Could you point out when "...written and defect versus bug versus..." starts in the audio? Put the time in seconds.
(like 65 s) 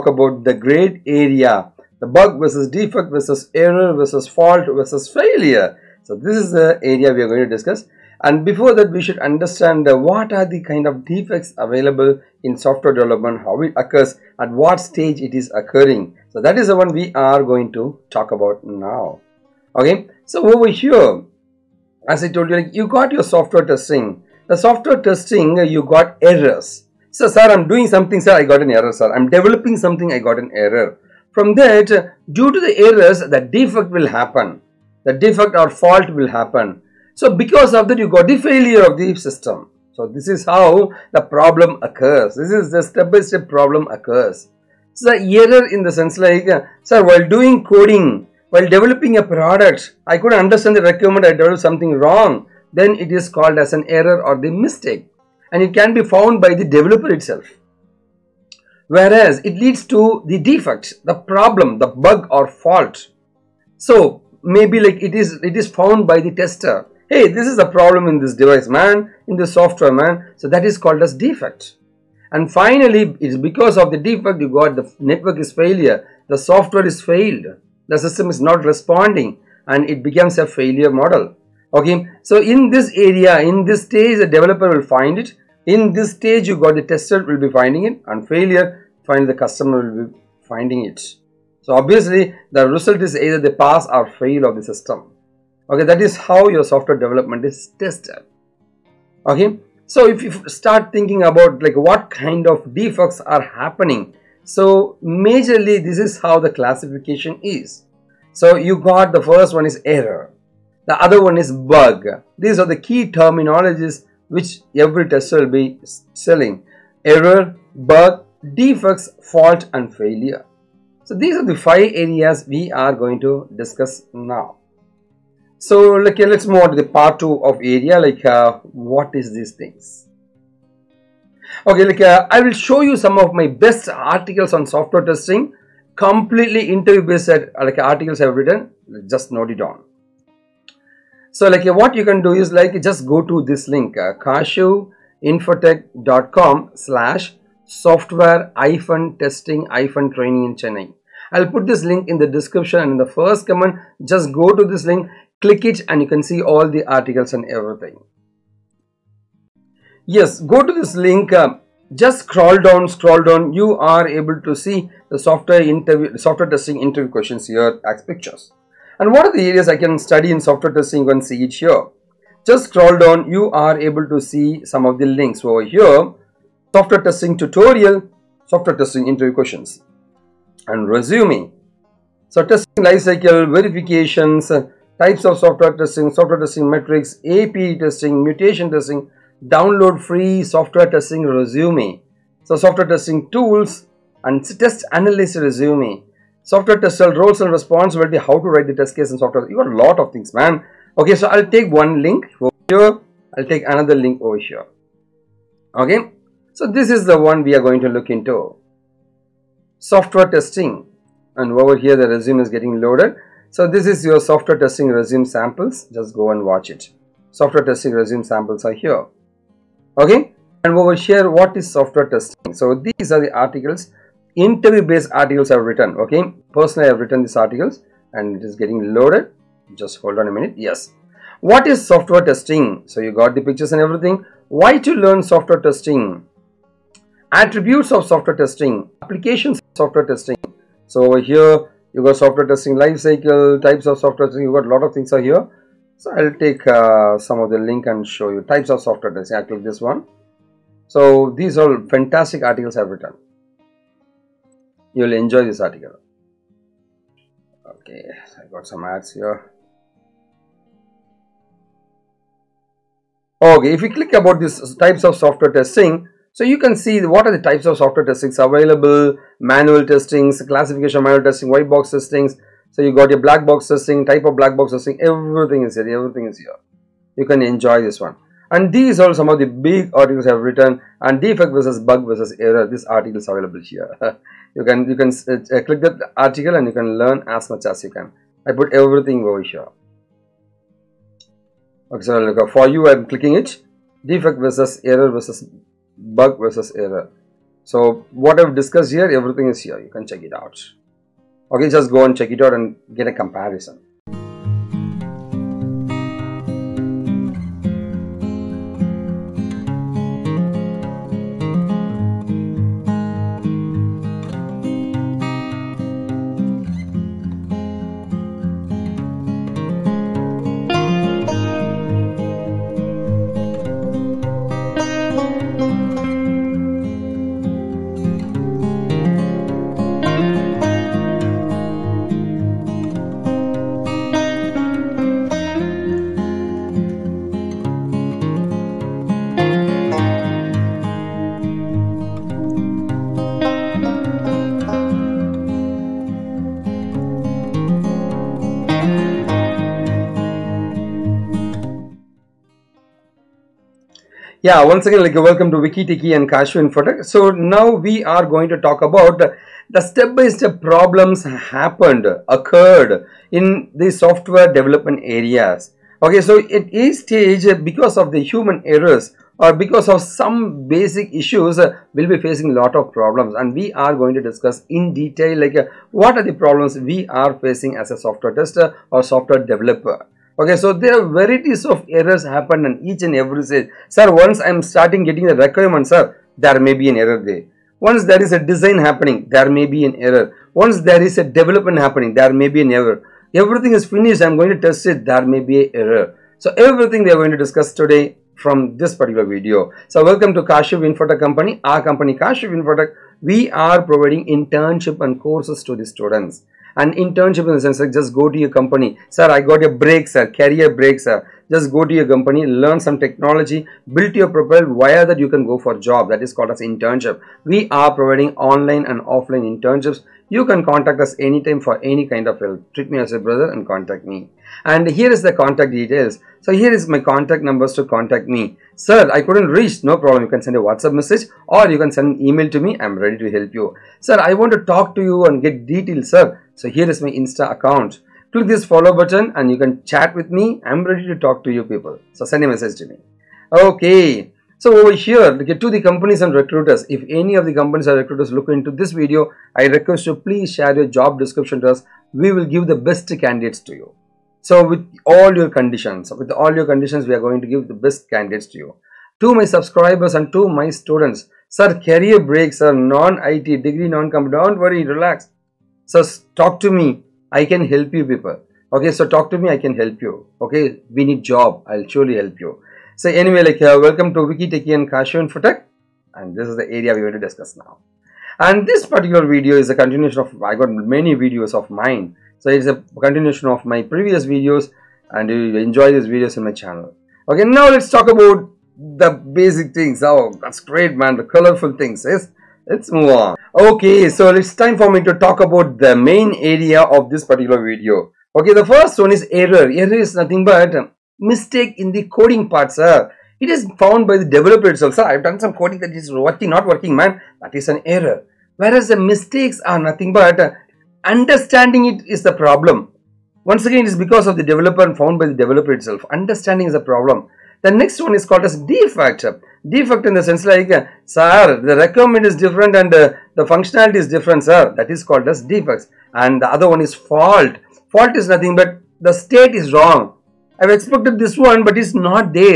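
280 s.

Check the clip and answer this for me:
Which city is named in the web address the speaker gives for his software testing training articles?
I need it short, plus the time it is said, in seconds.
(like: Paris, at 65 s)
Chennai, at 150 s.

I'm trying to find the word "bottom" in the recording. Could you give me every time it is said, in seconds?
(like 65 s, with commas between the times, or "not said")
not said.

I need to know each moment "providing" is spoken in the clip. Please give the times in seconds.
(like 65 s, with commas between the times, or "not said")
403 s, 417 s.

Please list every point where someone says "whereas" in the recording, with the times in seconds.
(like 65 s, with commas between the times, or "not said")
58 s, 508 s.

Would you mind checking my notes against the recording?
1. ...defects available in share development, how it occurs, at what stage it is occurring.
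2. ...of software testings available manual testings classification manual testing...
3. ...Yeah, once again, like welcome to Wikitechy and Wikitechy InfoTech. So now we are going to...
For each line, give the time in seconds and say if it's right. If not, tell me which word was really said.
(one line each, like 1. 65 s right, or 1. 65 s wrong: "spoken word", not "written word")
1. 11 s wrong: "software", not "share"
2. 267 s right
3. 354 s wrong: "KaaShiv", not "Wikitechy".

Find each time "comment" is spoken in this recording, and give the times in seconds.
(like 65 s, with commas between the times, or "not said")
153 s.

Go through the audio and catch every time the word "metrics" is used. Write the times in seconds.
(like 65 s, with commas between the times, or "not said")
186 s.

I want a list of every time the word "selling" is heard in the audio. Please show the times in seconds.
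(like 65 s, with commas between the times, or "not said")
116 s.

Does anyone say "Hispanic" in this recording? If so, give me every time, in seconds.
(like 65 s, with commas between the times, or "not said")
not said.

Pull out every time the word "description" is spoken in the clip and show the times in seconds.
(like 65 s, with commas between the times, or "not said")
152 s, 451 s.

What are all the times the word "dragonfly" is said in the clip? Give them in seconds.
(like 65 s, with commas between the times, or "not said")
not said.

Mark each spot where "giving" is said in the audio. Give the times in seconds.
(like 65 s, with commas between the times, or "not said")
not said.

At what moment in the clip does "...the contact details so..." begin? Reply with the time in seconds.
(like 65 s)
425 s.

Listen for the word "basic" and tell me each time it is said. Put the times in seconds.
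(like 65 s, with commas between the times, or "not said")
370 s, 489 s.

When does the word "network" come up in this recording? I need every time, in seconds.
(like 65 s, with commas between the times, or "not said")
74 s.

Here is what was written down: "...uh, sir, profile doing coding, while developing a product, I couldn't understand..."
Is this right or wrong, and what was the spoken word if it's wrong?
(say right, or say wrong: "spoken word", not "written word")
wrong: "while", not "profile".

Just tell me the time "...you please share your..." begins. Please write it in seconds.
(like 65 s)
450 s.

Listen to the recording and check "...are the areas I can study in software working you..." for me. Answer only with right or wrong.
wrong.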